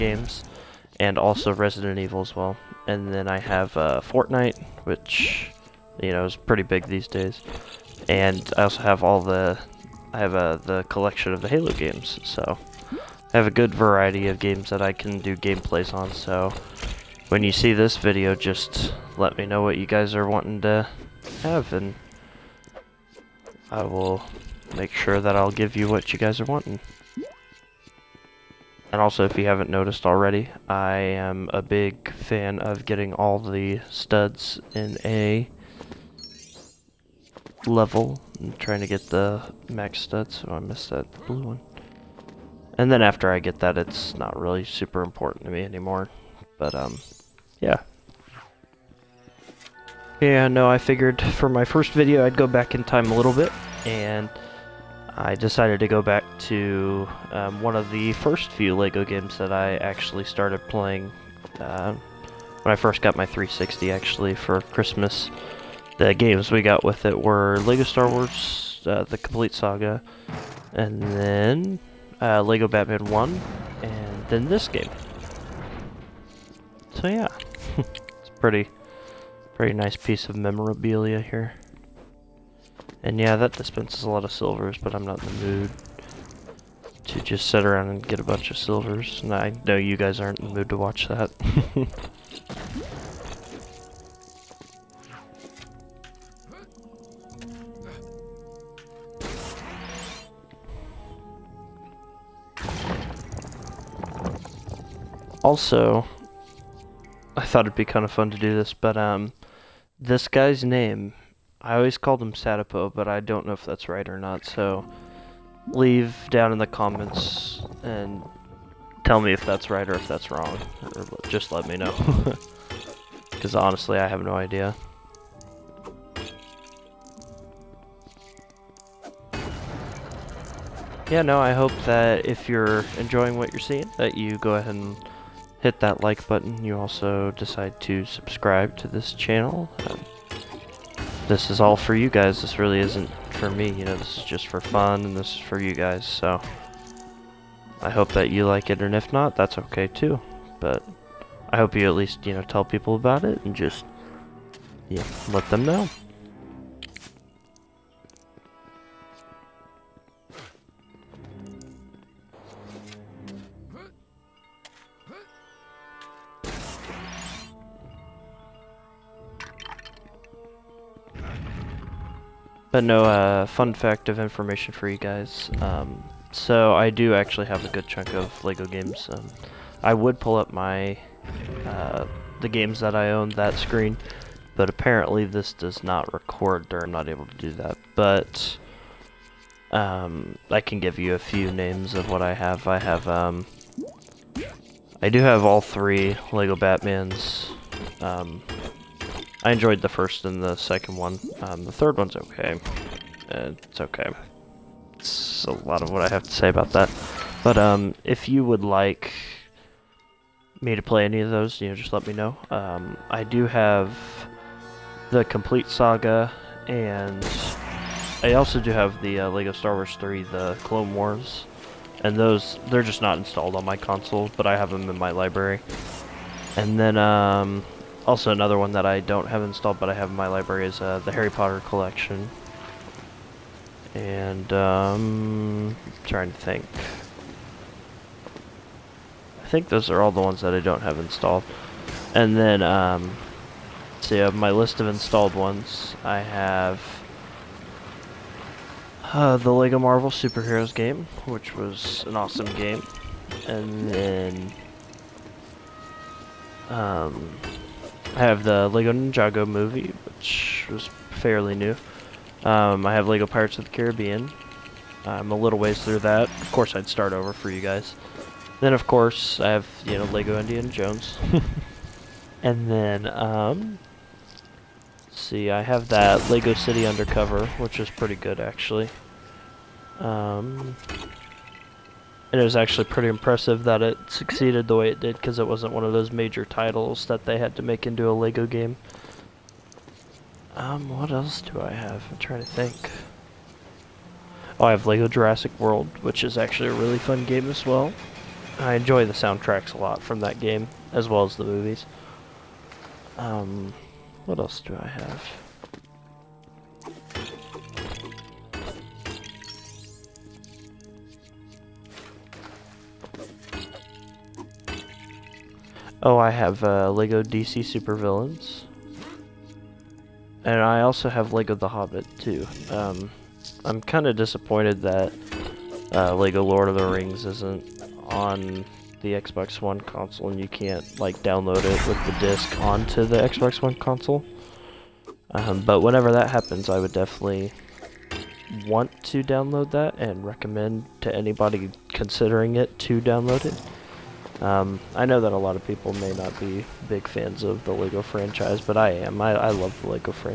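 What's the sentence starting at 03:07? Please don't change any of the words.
But um, I can give you a few names of what I have.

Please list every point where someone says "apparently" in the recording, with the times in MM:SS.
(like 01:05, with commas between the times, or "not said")
03:04.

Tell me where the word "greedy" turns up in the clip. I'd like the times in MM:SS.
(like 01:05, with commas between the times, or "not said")
not said.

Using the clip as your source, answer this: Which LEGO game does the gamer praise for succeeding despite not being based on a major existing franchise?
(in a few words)
Lego City Undercover.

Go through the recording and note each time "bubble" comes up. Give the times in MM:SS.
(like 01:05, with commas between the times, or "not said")
not said.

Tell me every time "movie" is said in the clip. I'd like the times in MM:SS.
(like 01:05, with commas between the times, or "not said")
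04:19, 05:01.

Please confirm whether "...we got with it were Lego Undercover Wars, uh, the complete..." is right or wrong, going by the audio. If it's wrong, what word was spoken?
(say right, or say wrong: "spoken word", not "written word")
wrong: "Star", not "Undercover".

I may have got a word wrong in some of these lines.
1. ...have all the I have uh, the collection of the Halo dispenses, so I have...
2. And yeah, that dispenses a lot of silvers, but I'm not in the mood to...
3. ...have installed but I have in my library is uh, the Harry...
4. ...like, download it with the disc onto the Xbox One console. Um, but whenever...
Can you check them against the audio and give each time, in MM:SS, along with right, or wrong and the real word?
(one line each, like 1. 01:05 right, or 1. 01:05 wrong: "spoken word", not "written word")
1. 00:08 wrong: "games", not "dispenses"
2. 01:23 right
3. 03:49 right
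4. 05:31 right.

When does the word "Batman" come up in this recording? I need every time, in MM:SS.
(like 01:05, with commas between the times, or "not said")
01:12, 03:16.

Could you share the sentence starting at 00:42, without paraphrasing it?
And then after I get that, it's not really super important to me anymore.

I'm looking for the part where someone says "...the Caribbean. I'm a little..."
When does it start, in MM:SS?
04:23.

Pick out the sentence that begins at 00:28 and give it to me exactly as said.
And also, if you haven't noticed already, I am a big fan of getting all the studs in a level.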